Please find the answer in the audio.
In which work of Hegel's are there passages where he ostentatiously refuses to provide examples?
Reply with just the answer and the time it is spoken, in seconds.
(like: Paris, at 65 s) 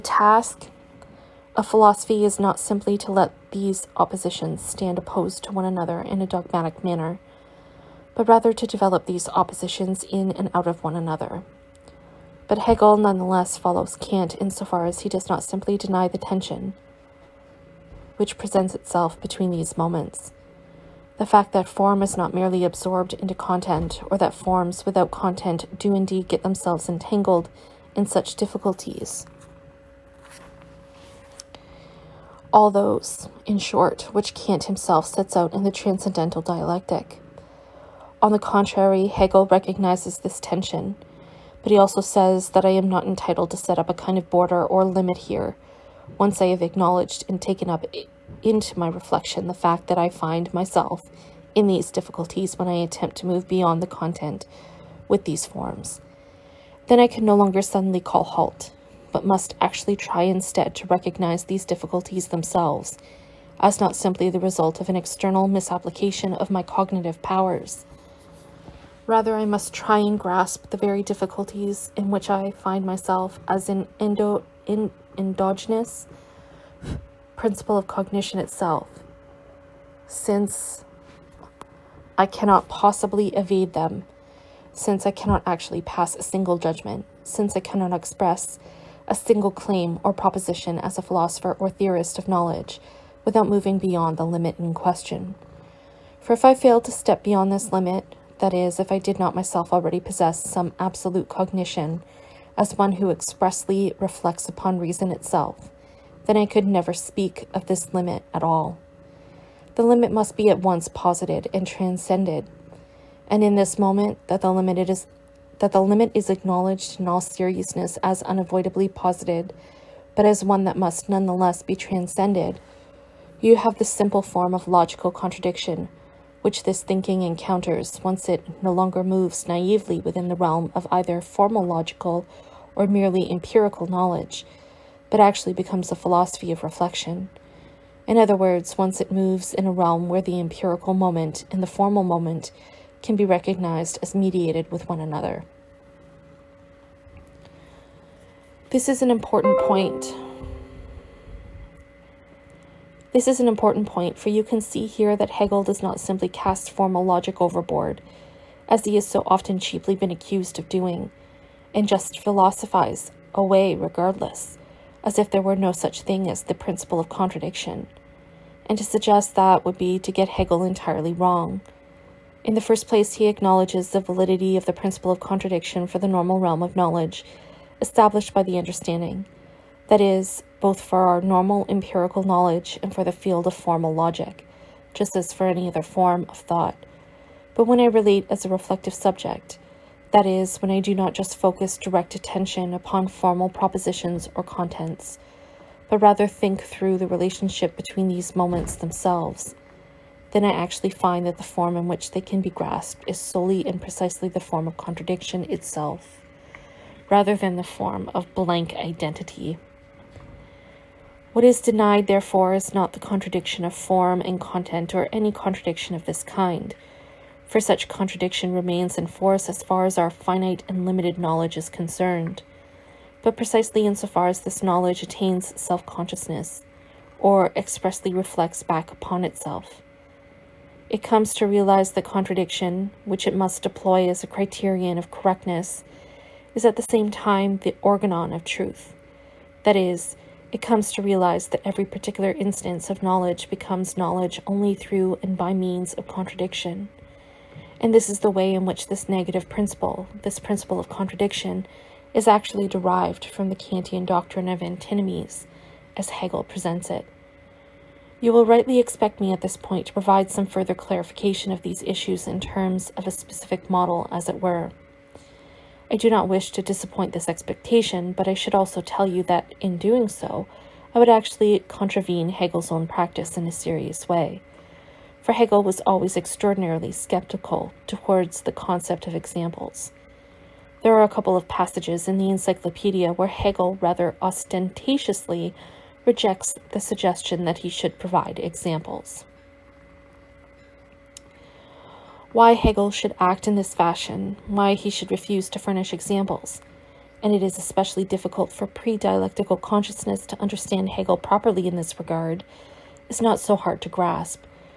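the Encyclopedia, at 282 s.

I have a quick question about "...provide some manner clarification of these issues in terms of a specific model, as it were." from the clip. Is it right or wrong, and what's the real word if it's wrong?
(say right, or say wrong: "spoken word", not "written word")
wrong: "further", not "manner".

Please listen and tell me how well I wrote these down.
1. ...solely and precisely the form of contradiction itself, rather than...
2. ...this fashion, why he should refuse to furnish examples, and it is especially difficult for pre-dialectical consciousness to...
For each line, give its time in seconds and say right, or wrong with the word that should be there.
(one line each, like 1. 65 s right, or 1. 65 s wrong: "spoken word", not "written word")
1. 203 s right
2. 293 s right.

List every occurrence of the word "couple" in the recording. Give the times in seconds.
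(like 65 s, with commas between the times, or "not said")
281 s.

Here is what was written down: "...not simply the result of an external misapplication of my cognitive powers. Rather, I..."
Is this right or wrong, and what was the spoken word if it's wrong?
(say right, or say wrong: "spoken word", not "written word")
right.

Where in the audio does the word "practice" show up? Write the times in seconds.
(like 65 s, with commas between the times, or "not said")
272 s.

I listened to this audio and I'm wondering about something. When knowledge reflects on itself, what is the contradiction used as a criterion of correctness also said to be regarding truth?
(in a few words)
the organon of truth.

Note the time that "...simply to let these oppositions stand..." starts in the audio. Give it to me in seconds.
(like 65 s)
2 s.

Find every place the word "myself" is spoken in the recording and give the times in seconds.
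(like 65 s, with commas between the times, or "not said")
50 s, 72 s, 99 s.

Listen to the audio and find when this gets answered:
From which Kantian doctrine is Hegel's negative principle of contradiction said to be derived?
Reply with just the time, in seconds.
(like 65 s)
254 s.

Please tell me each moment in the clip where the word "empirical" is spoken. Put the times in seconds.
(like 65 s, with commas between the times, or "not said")
133 s, 140 s, 181 s.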